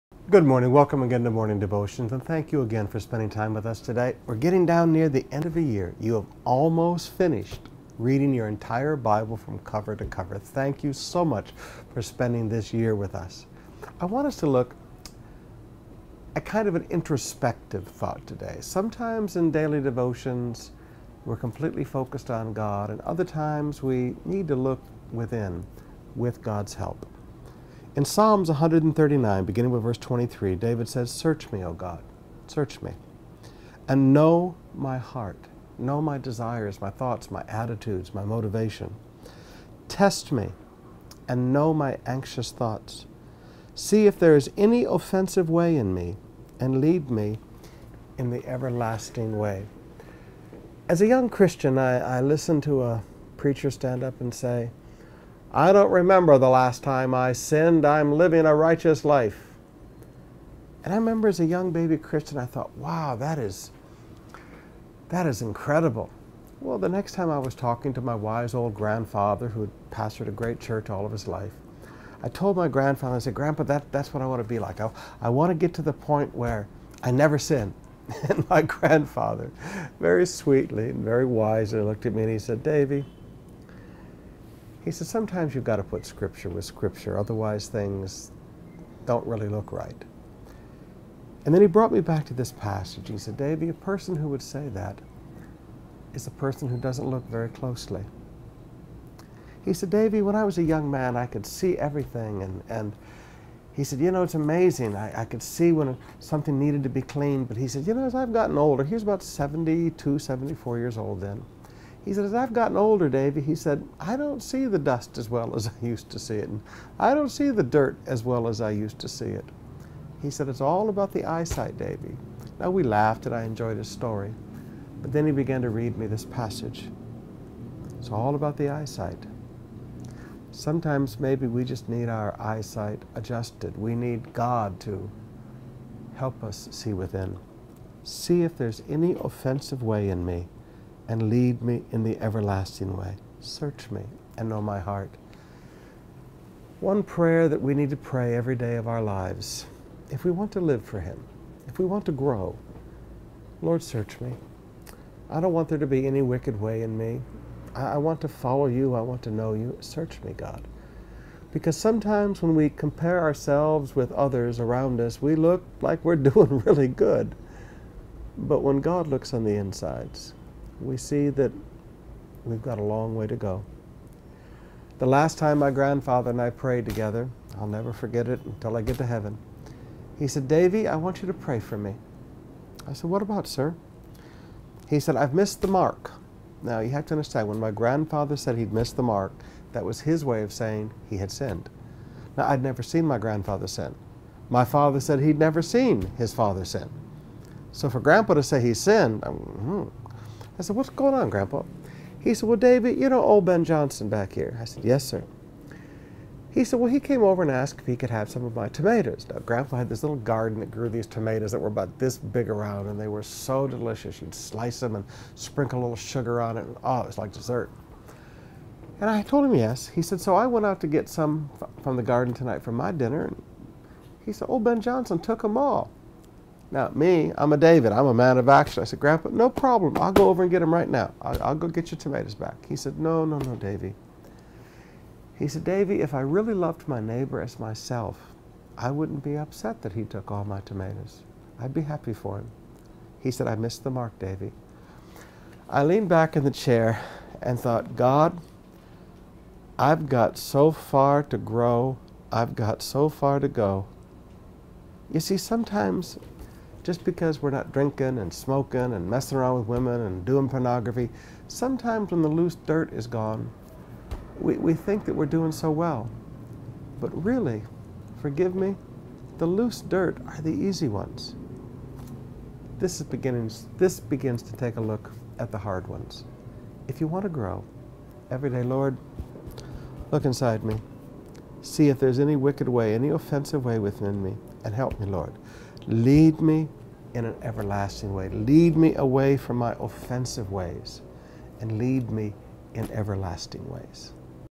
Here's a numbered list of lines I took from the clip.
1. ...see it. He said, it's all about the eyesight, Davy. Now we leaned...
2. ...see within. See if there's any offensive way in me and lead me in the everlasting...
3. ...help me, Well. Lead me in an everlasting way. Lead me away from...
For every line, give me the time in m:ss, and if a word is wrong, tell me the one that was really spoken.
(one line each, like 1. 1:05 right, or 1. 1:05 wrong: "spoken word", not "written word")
1. 1:59 wrong: "laughed", not "leaned"
2. 2:16 right
3. 4:44 wrong: "Lord", not "Well".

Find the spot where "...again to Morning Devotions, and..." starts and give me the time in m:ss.
0:01.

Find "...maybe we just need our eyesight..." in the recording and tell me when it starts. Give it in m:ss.
2:11.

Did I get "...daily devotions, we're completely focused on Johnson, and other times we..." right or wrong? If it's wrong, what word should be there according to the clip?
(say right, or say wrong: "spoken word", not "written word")
wrong: "God", not "Johnson".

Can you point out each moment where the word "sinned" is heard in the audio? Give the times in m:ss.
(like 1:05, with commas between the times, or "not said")
0:57, 3:11, 3:18.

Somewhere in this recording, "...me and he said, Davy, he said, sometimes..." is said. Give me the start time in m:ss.
1:22.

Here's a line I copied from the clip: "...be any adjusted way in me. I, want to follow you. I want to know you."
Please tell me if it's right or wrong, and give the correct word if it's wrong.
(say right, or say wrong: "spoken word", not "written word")
wrong: "wicked", not "adjusted".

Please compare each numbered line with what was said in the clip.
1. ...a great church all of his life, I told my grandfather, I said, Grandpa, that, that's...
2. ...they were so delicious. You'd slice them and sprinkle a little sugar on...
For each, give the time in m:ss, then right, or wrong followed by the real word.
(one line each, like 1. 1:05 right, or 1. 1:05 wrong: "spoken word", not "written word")
1. 1:10 right
2. 3:32 right.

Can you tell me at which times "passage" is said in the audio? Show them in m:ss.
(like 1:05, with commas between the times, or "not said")
1:32, 2:06.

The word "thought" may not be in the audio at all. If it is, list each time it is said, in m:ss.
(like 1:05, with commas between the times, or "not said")
0:17, 0:36, 0:42, 1:02, 4:07.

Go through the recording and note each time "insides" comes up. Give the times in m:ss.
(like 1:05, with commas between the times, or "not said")
2:49, 4:40.